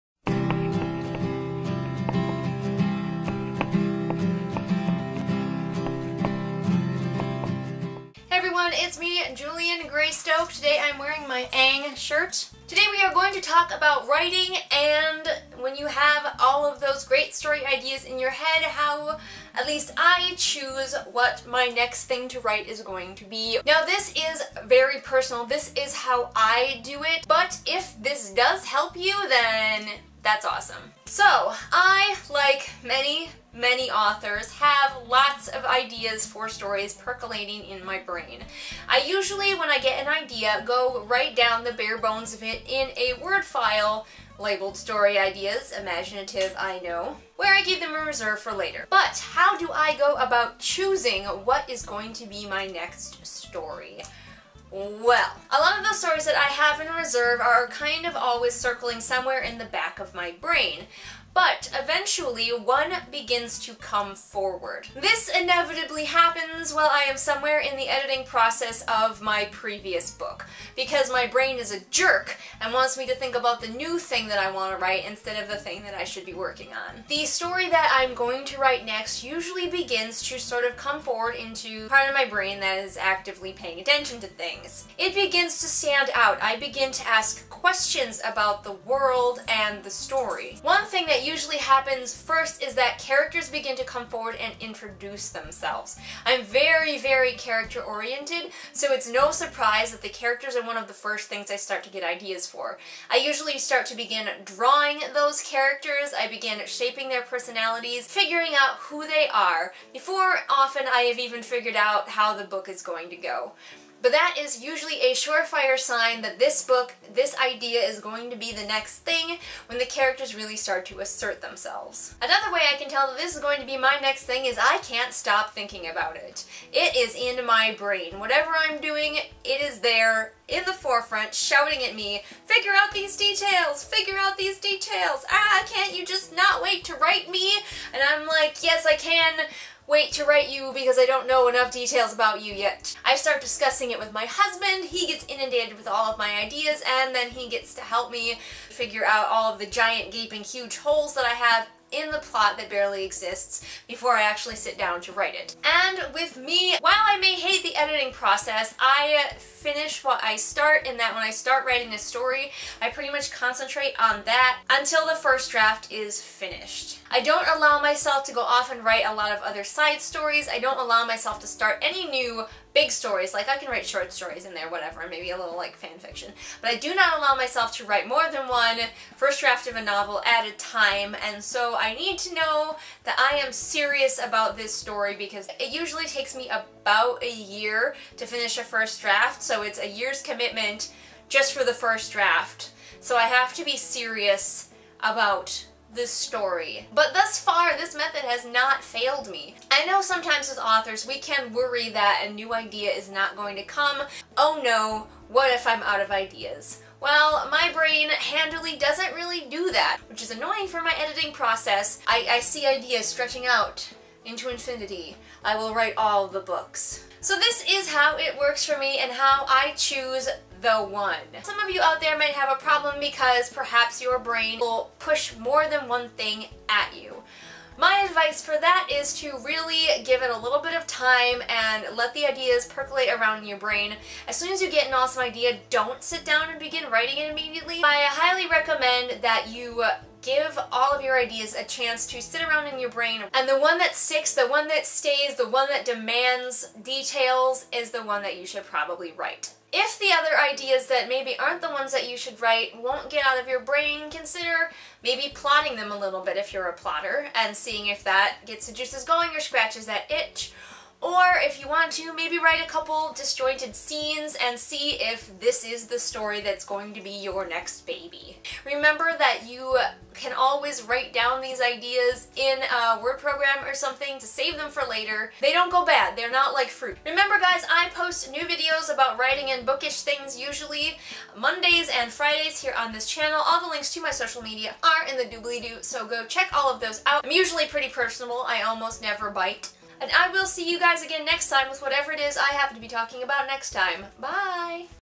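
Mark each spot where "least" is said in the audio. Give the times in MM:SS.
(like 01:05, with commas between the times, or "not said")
00:19.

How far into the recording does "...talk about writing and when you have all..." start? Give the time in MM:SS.
00:13.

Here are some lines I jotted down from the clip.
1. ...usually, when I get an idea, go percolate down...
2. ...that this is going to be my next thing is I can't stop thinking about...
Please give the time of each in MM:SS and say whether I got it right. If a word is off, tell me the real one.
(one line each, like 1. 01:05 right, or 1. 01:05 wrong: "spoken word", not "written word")
1. 00:39 wrong: "write", not "percolate"
2. 02:03 right.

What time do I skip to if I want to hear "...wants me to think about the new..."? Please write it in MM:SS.
01:12.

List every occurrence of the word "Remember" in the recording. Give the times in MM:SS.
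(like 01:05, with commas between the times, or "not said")
04:28, 04:37.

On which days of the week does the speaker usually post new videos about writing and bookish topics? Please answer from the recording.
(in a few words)
Mondays and Fridays.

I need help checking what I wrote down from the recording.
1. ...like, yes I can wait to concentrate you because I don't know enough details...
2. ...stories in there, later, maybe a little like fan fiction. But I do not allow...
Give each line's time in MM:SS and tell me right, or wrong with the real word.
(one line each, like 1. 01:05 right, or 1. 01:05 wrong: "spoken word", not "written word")
1. 02:18 wrong: "write", not "concentrate"
2. 02:54 wrong: "whatever", not "later".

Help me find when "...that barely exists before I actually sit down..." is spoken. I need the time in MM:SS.
02:32.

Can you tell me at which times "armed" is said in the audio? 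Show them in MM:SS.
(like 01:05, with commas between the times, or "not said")
not said.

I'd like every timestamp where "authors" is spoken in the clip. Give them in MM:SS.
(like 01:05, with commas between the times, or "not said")
00:33, 03:20.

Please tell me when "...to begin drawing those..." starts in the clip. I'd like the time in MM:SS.
01:43.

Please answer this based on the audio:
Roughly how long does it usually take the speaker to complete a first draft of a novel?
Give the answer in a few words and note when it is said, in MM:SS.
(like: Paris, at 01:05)
About a year, at 03:06.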